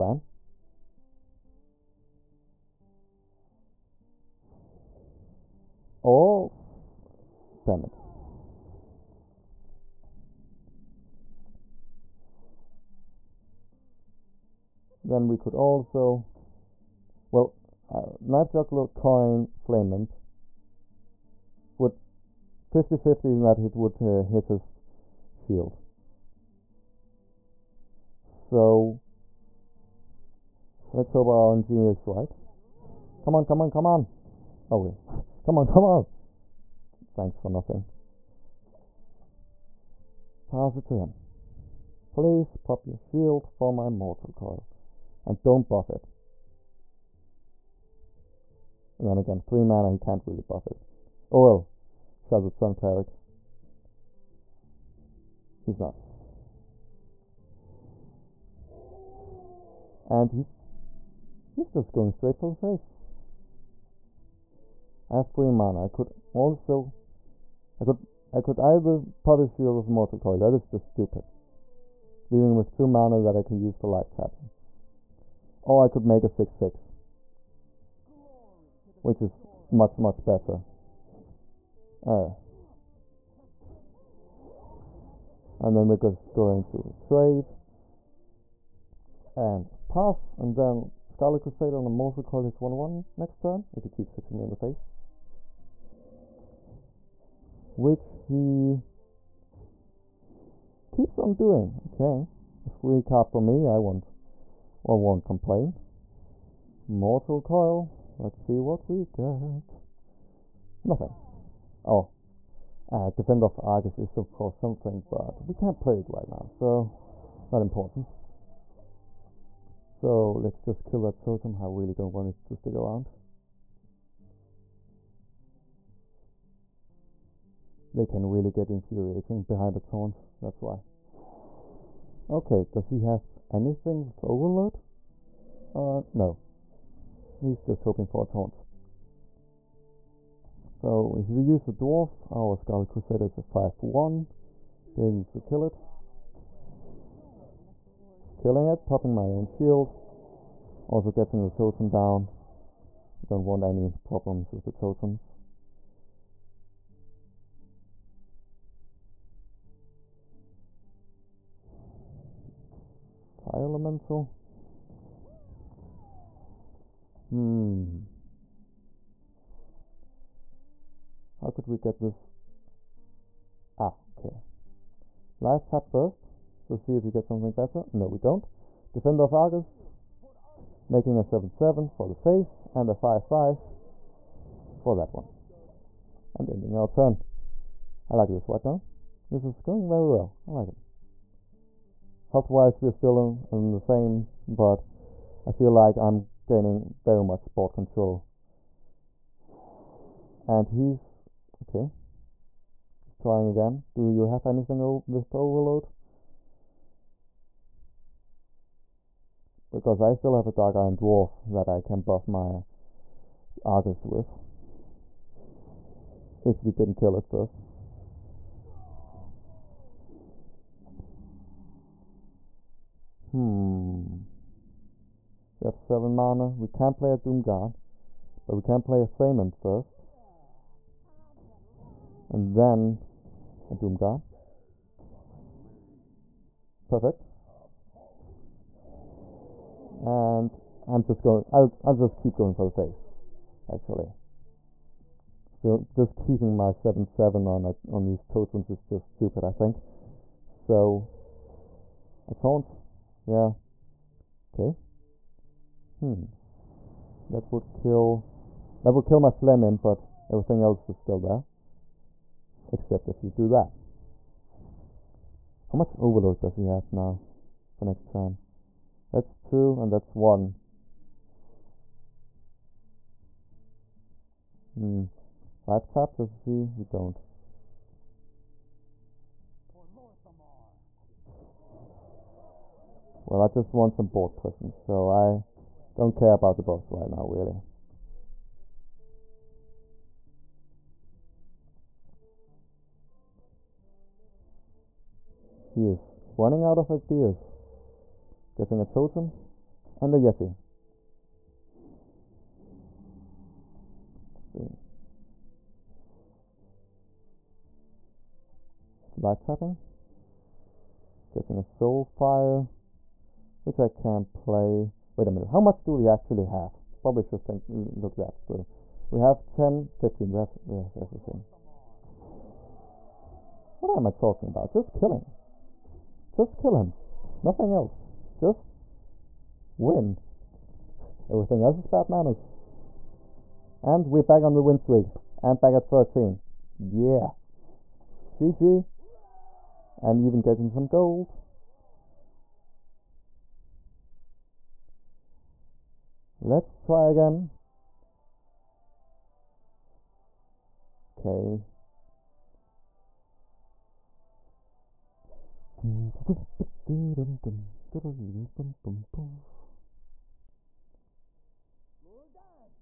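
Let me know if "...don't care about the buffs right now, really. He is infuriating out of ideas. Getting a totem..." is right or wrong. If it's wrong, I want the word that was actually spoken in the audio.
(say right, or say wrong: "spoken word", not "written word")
wrong: "running", not "infuriating".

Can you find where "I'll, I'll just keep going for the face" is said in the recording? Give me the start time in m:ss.
4:01.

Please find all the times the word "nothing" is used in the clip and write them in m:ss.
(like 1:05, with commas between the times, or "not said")
0:37, 1:50, 5:27.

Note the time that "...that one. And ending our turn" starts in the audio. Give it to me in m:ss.
3:04.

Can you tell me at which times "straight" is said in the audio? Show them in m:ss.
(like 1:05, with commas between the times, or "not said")
1:02.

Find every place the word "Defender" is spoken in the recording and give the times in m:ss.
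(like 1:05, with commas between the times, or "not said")
1:53, 2:58.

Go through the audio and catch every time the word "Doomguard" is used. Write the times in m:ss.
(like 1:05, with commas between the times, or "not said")
3:47, 3:53.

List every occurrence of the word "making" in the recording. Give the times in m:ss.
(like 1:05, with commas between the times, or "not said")
3:00.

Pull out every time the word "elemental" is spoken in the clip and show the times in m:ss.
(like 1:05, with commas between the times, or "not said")
2:43.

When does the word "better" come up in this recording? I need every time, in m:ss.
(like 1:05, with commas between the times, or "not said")
1:20, 2:57.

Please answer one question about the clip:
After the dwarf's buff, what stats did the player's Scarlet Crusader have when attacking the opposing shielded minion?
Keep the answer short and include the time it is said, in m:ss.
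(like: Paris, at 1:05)
5-1, at 2:23.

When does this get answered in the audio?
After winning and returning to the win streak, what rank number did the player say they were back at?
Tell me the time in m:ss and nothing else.
5:35.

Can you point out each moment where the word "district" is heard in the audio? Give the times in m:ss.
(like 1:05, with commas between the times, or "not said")
not said.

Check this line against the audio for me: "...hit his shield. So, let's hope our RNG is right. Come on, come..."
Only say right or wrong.
right.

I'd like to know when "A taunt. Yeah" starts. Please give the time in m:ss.
4:12.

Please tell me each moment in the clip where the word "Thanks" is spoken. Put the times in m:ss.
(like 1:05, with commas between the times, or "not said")
0:37.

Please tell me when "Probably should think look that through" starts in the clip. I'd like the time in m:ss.
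5:17.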